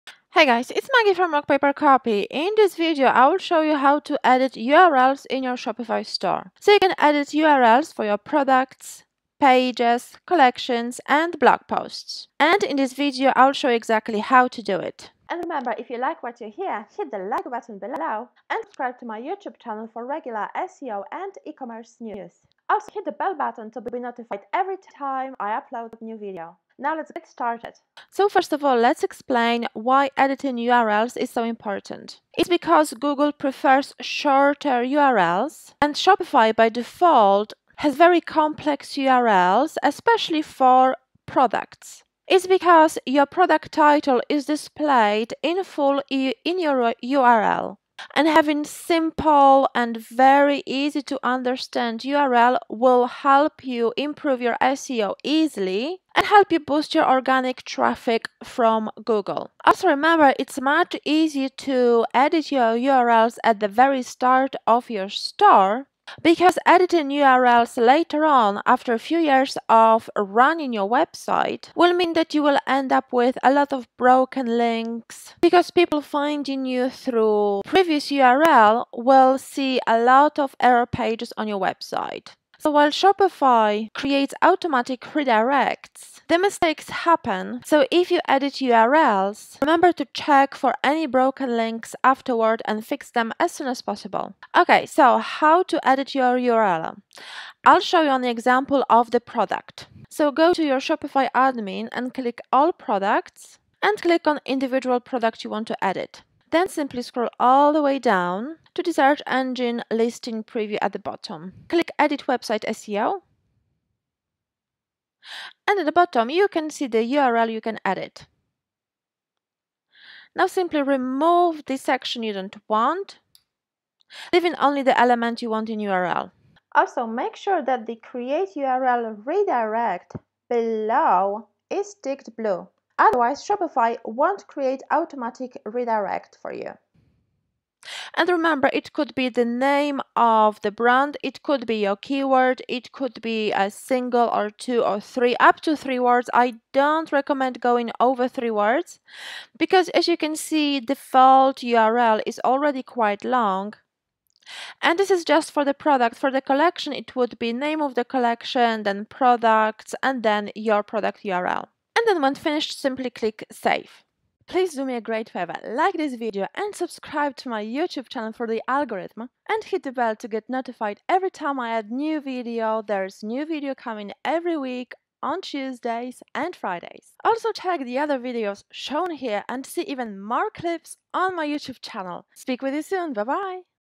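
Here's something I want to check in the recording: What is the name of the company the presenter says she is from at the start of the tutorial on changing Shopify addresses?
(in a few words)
Rock Paper Copy.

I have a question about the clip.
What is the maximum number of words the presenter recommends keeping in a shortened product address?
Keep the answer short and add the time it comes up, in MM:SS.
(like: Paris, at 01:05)
3, at 02:25.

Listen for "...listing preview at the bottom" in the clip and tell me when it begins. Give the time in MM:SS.
01:49.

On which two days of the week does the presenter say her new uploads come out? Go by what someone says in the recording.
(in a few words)
Tuesdays and Fridays.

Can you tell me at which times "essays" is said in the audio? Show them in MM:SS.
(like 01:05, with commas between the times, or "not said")
not said.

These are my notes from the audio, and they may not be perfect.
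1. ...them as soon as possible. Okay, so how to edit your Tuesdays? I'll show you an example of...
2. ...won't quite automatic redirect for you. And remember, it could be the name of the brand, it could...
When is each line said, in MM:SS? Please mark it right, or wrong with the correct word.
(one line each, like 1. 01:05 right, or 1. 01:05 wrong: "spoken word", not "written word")
1. 01:33 wrong: "URL", not "Tuesdays"
2. 02:14 wrong: "create", not "quite".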